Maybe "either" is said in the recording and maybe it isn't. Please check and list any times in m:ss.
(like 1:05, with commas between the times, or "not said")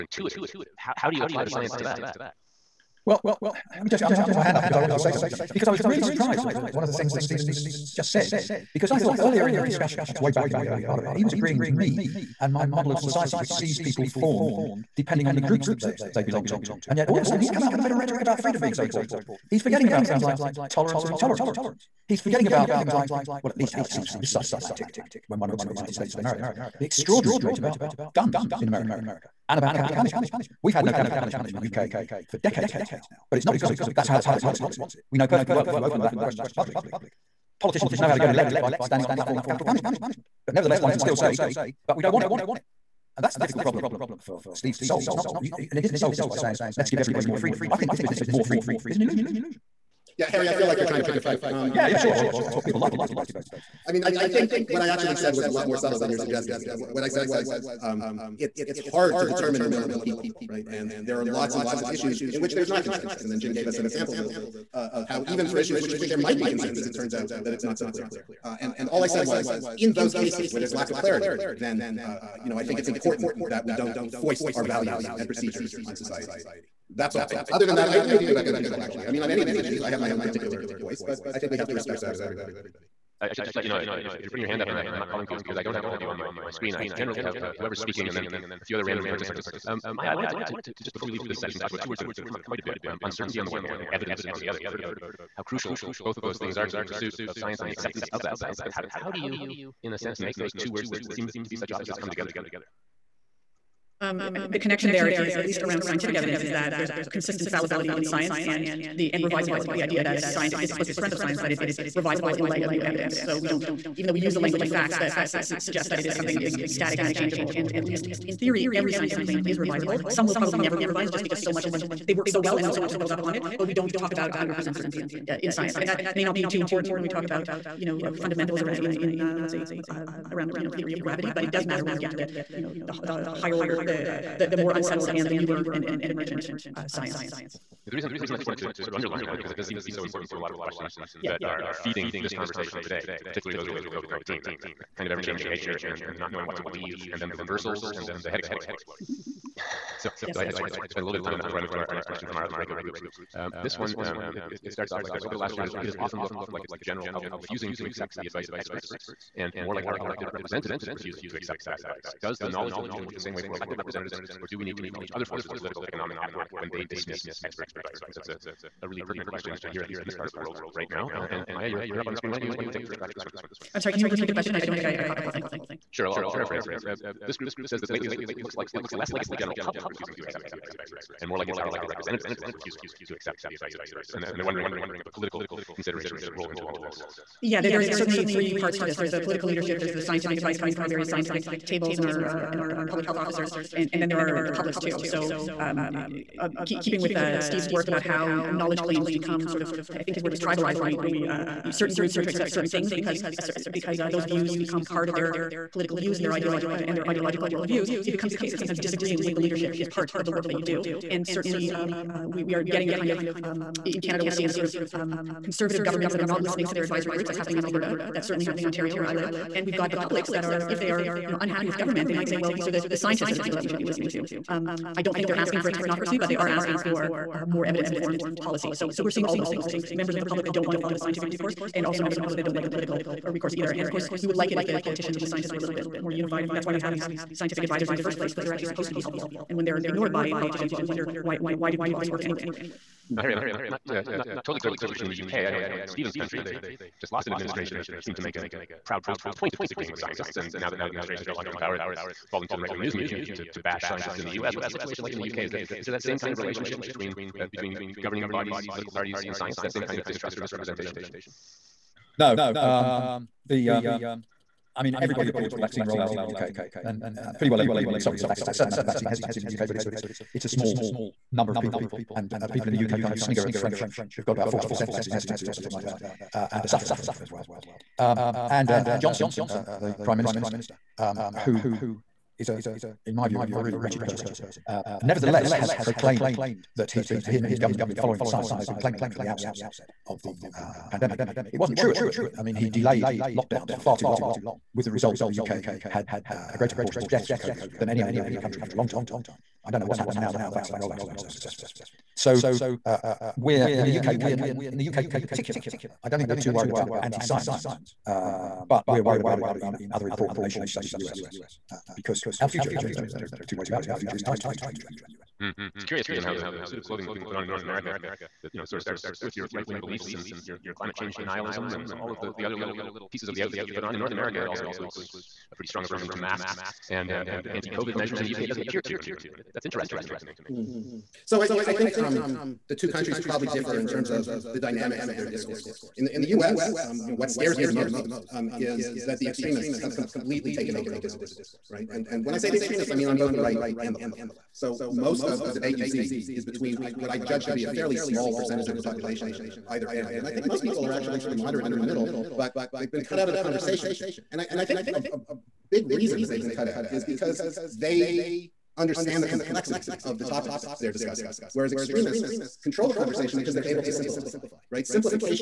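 3:53, 5:49.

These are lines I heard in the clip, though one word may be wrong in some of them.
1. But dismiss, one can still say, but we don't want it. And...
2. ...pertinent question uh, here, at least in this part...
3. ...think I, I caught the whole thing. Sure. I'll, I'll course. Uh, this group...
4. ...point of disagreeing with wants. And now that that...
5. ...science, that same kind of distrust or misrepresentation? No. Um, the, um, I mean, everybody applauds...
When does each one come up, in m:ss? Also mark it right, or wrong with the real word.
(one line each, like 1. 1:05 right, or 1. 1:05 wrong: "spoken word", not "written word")
1. 0:40 wrong: "nevertheless", not "dismiss"
2. 2:49 right
3. 2:54 wrong: "paraphrase", not "course"
4. 4:09 wrong: "scientists", not "wants"
5. 4:19 right.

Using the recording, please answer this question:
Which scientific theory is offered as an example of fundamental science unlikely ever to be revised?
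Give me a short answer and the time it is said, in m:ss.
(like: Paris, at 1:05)
theory of gravity, at 2:10.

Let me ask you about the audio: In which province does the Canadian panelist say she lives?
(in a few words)
Ontario.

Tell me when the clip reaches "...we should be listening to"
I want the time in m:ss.
3:43.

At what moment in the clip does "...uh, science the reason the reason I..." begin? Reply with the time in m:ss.
2:16.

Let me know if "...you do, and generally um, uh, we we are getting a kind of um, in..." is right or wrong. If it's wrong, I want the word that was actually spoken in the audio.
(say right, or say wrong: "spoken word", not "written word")
wrong: "certainly", not "generally".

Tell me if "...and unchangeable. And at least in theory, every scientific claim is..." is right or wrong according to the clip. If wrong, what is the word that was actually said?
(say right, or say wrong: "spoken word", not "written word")
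right.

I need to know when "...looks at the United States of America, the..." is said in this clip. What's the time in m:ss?
0:25.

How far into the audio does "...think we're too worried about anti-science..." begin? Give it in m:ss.
5:06.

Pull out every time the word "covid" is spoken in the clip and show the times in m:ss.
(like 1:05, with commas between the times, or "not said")
2:23, 4:57, 5:27.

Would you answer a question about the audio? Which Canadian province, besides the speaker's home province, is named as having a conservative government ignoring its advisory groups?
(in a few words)
Alberta.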